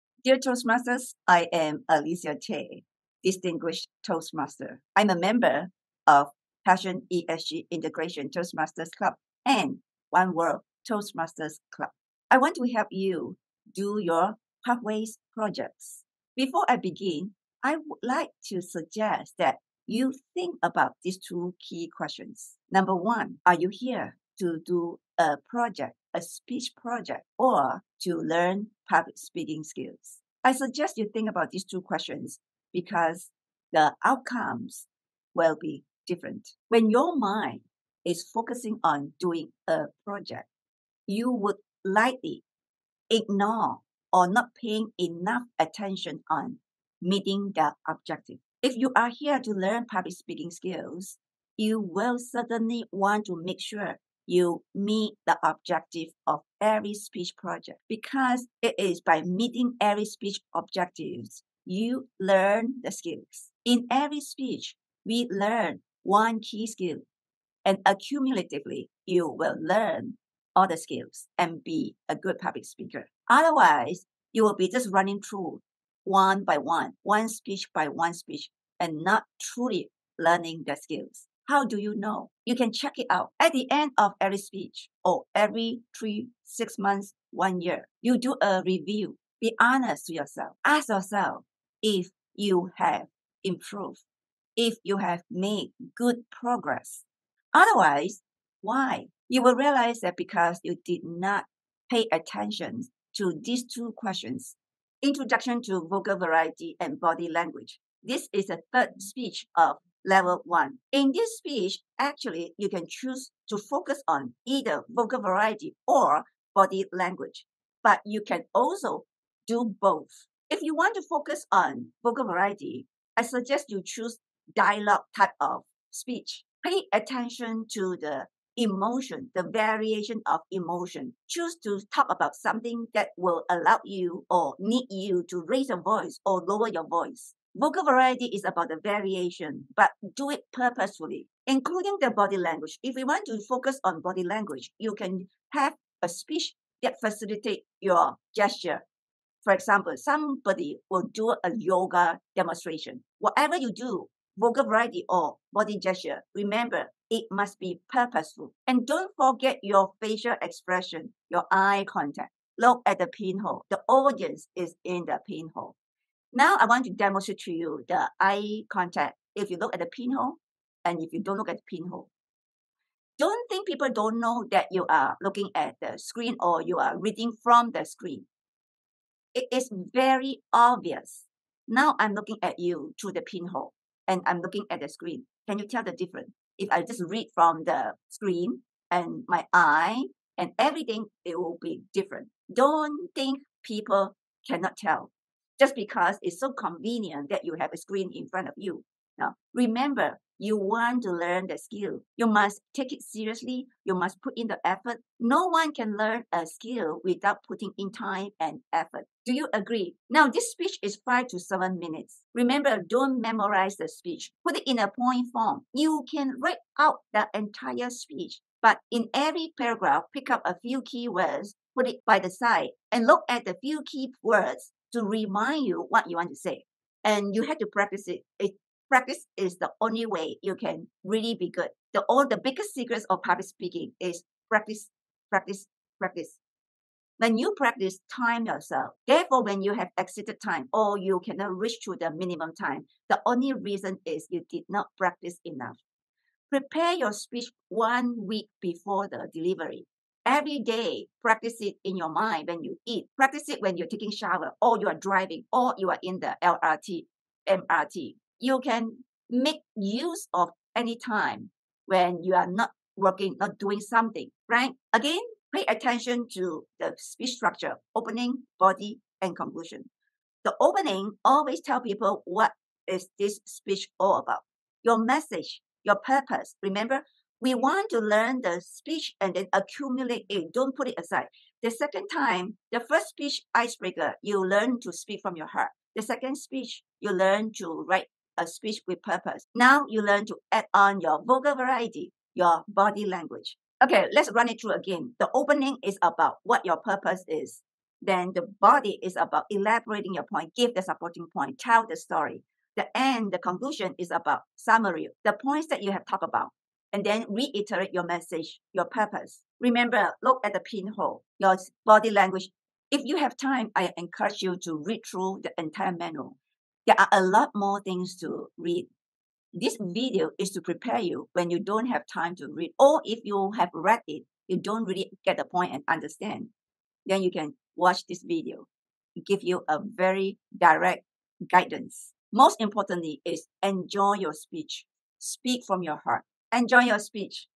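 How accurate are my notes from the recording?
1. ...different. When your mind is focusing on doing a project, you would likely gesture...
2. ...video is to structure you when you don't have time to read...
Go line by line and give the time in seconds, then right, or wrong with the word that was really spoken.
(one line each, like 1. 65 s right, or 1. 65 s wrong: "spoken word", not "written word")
1. 36 s wrong: "ignore", not "gesture"
2. 319 s wrong: "prepare", not "structure".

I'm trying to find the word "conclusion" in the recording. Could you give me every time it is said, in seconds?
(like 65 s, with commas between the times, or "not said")
269 s, 303 s.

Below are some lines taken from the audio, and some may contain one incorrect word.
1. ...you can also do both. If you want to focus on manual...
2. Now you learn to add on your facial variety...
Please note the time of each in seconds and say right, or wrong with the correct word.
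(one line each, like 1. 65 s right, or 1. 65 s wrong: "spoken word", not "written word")
1. 118 s wrong: "vocal", not "manual"
2. 289 s wrong: "vocal", not "facial".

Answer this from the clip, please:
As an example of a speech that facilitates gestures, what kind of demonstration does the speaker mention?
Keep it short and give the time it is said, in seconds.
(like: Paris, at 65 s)
Yoga demonstration, at 151 s.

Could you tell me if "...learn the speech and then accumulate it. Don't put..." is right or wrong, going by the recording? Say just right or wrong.
right.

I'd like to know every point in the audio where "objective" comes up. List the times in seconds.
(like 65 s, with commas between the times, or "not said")
47 s, 55 s, 60 s.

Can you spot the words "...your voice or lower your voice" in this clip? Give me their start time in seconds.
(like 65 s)
135 s.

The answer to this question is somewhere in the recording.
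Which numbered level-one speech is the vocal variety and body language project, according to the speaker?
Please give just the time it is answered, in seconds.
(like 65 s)
108 s.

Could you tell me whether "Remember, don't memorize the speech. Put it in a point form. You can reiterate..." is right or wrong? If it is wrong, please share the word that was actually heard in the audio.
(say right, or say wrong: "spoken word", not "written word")
wrong: "write", not "reiterate".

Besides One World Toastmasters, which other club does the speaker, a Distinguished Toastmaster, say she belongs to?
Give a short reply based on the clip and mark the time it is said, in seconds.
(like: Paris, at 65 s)
Passion ESG Integration Toastmasters Club, at 6 s.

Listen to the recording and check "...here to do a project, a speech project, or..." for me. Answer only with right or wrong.
right.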